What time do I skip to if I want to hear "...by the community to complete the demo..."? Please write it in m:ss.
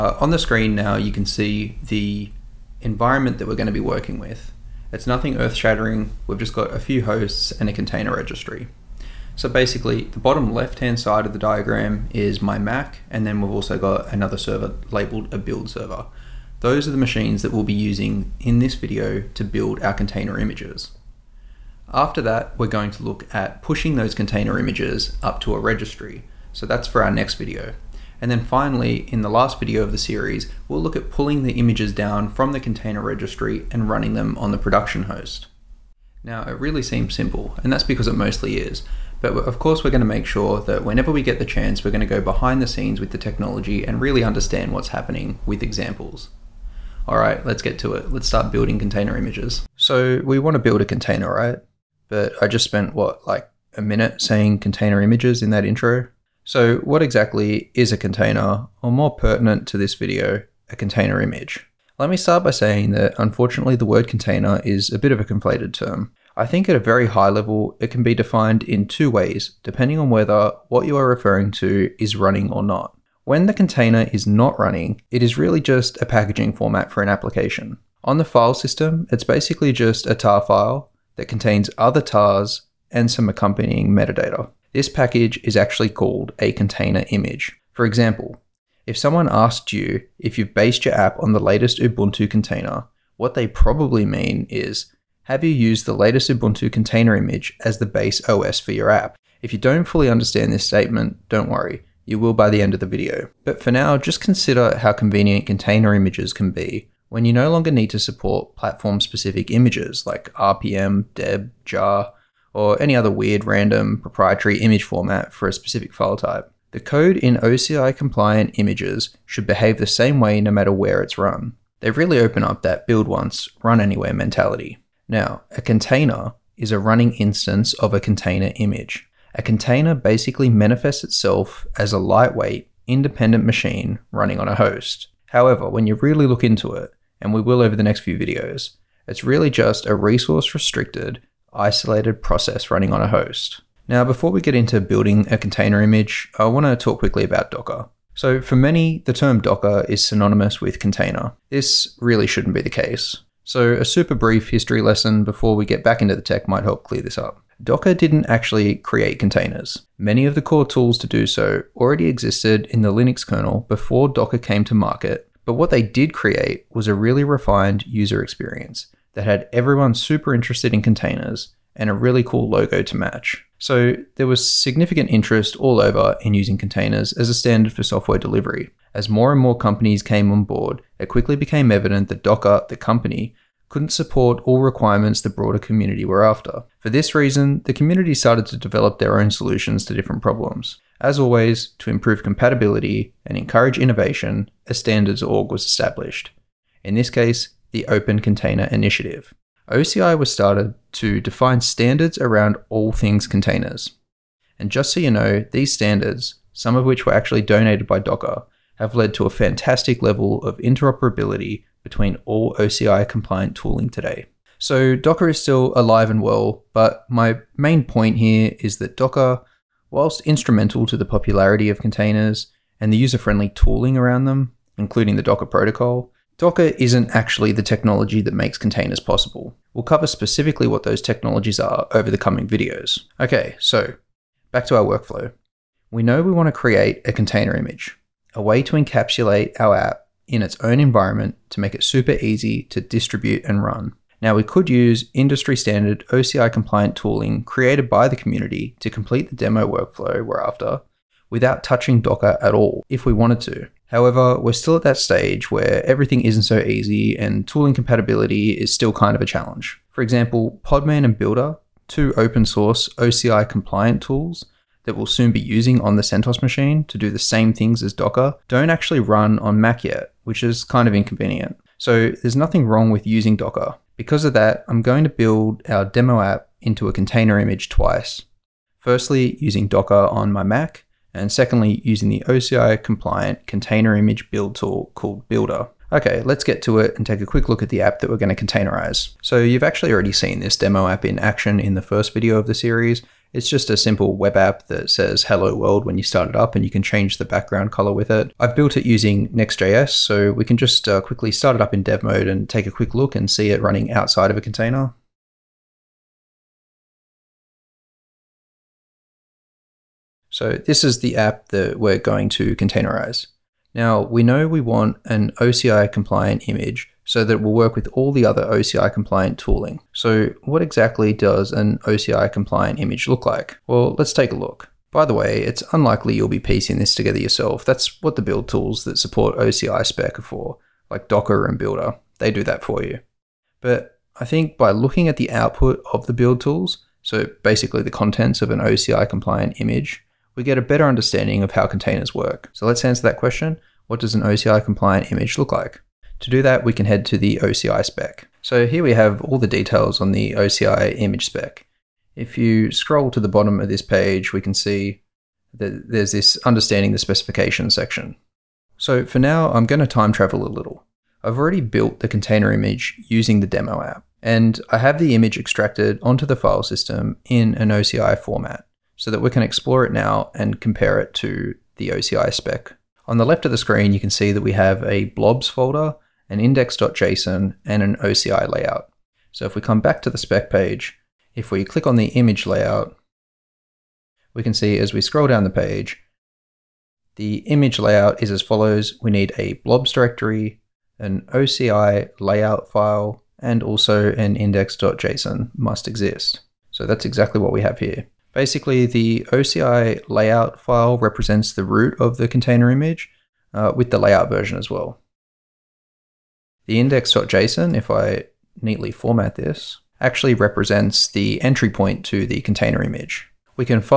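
4:07.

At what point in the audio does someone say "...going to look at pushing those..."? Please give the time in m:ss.
0:22.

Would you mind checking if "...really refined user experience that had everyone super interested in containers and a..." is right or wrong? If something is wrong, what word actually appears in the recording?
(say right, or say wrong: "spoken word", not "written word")
right.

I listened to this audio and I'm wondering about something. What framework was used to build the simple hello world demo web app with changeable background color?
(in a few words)
Next.js.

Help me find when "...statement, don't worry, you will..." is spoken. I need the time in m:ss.
1:40.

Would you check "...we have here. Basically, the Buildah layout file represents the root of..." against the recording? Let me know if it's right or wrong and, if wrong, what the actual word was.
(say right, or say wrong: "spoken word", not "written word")
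wrong: "OCI", not "Buildah".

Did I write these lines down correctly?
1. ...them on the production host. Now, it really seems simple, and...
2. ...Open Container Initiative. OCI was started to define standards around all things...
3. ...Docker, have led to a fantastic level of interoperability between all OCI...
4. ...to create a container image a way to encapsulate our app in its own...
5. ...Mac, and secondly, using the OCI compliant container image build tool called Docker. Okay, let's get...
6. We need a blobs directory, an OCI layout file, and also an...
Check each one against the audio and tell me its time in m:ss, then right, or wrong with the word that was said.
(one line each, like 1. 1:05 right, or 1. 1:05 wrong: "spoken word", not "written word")
1. 0:34 right
2. 3:17 right
3. 3:28 right
4. 3:56 right
5. 4:40 wrong: "Buildah", not "Docker"
6. 6:29 right.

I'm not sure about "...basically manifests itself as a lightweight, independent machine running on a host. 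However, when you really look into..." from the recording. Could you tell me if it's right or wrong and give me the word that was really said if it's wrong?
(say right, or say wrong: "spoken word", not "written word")
right.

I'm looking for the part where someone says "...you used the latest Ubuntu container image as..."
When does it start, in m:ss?
1:35.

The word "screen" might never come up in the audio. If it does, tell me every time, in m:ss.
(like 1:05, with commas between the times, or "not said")
0:00, 6:13.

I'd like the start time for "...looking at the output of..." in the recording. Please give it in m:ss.
5:34.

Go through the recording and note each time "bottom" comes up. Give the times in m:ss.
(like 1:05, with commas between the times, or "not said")
0:10, 5:53.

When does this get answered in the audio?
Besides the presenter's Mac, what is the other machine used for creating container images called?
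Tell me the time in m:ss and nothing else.
0:15.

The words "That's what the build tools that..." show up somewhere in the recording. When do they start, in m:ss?
5:27.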